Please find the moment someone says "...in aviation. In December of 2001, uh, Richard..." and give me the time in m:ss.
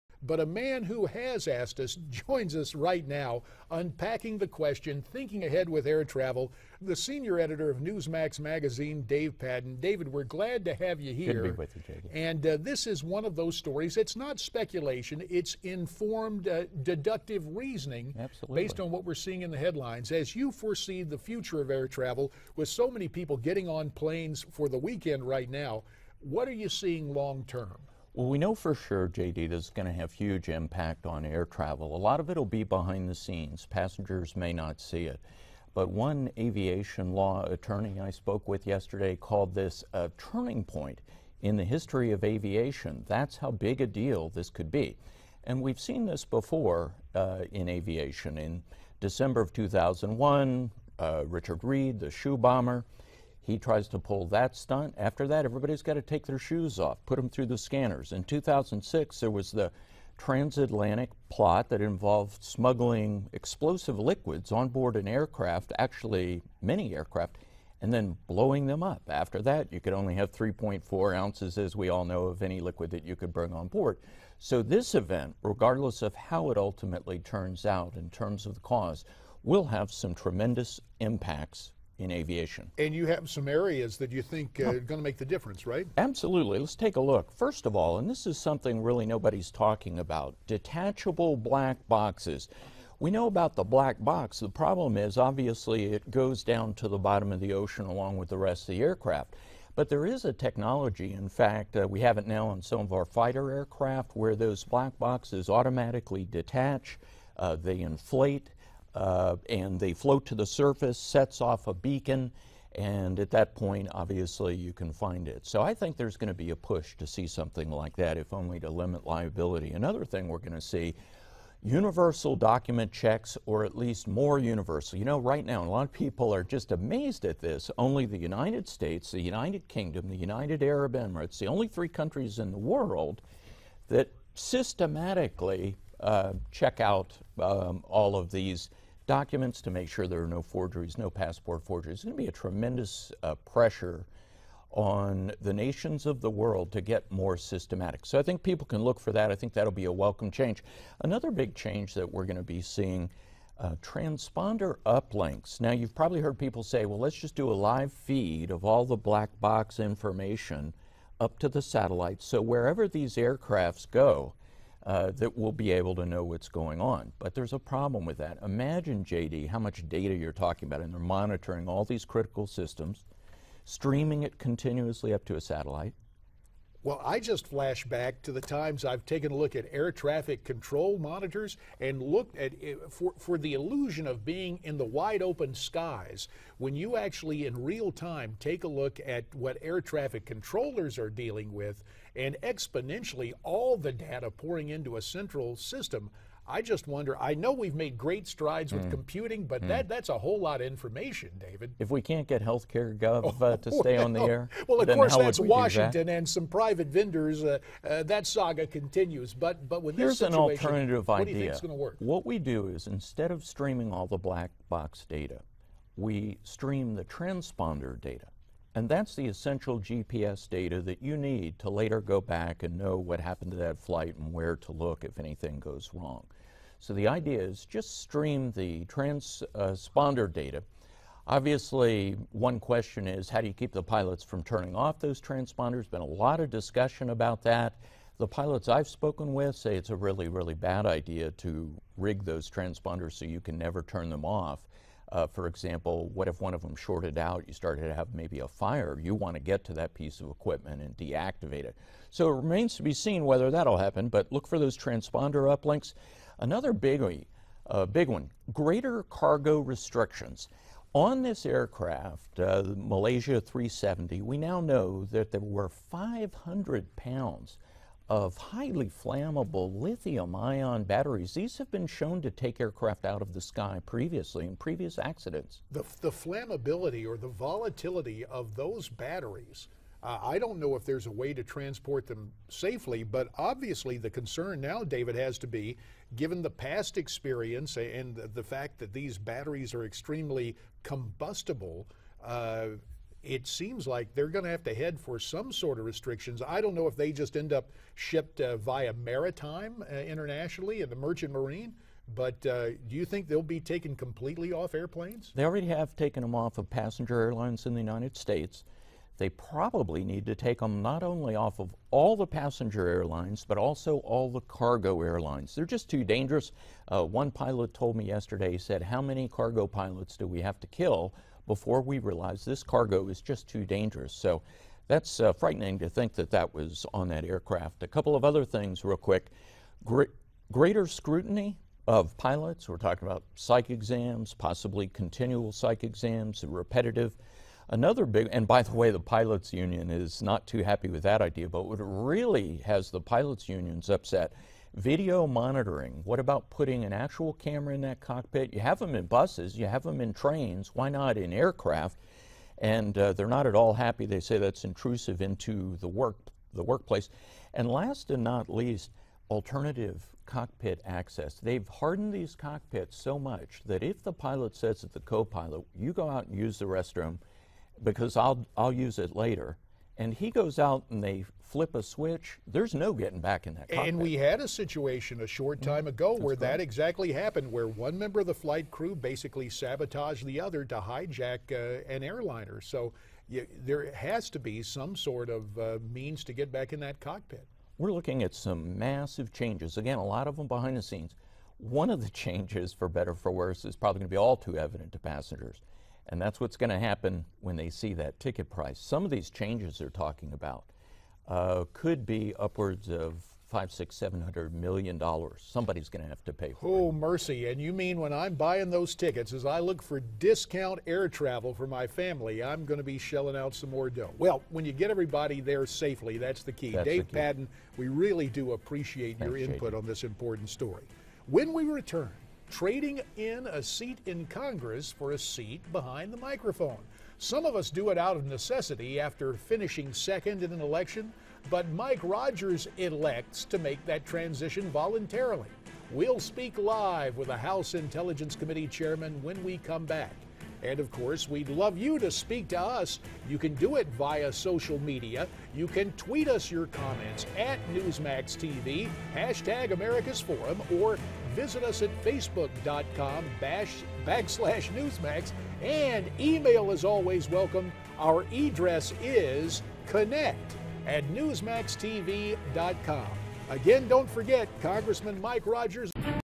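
0:47.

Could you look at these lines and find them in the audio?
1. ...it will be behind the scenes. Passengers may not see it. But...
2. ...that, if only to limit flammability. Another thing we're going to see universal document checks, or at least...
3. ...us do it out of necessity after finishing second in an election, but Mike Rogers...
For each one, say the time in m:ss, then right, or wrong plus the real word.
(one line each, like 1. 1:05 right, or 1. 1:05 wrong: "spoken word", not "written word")
1. 0:32 right
2. 1:57 wrong: "liability", not "flammability"
3. 7:07 right.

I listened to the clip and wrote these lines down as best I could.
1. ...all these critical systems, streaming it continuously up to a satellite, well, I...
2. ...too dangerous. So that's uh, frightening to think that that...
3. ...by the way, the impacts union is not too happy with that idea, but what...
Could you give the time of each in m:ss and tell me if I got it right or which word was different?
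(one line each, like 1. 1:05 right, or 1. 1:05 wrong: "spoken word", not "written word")
1. 2:51 right
2. 5:23 right
3. 5:38 wrong: "pilots", not "impacts".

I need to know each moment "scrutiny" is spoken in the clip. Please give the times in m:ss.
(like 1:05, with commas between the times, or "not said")
5:30.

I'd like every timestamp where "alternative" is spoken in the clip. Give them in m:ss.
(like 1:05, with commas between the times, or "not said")
3:30, 5:59.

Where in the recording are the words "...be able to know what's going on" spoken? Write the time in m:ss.
2:45.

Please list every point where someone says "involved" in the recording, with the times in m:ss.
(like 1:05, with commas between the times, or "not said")
1:01.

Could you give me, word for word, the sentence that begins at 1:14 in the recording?
So, this event, regardless of how it ultimately turns out in terms of the cause, will have some tremendous impacts in aviation.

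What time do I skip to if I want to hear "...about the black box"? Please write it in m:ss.
1:33.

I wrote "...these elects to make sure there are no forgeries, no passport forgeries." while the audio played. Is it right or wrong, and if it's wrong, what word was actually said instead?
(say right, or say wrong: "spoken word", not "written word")
wrong: "documents", not "elects".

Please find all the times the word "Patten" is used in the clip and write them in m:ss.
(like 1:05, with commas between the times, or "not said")
0:09, 6:57.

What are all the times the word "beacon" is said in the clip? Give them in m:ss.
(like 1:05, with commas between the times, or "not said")
1:51.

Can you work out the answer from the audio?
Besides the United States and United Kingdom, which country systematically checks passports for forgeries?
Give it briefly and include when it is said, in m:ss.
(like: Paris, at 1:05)
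United Arab Emirates, at 2:10.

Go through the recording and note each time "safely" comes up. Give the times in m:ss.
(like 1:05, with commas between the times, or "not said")
4:42, 6:55.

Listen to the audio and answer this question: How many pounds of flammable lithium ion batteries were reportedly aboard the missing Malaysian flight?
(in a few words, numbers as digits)
500.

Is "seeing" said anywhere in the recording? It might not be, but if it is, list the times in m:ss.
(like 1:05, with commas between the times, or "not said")
0:19, 0:26, 2:32.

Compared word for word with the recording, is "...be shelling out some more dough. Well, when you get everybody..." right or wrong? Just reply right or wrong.
right.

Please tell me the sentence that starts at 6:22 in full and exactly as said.
So you, there has to be some sort of uh, means to get back in that cockpit.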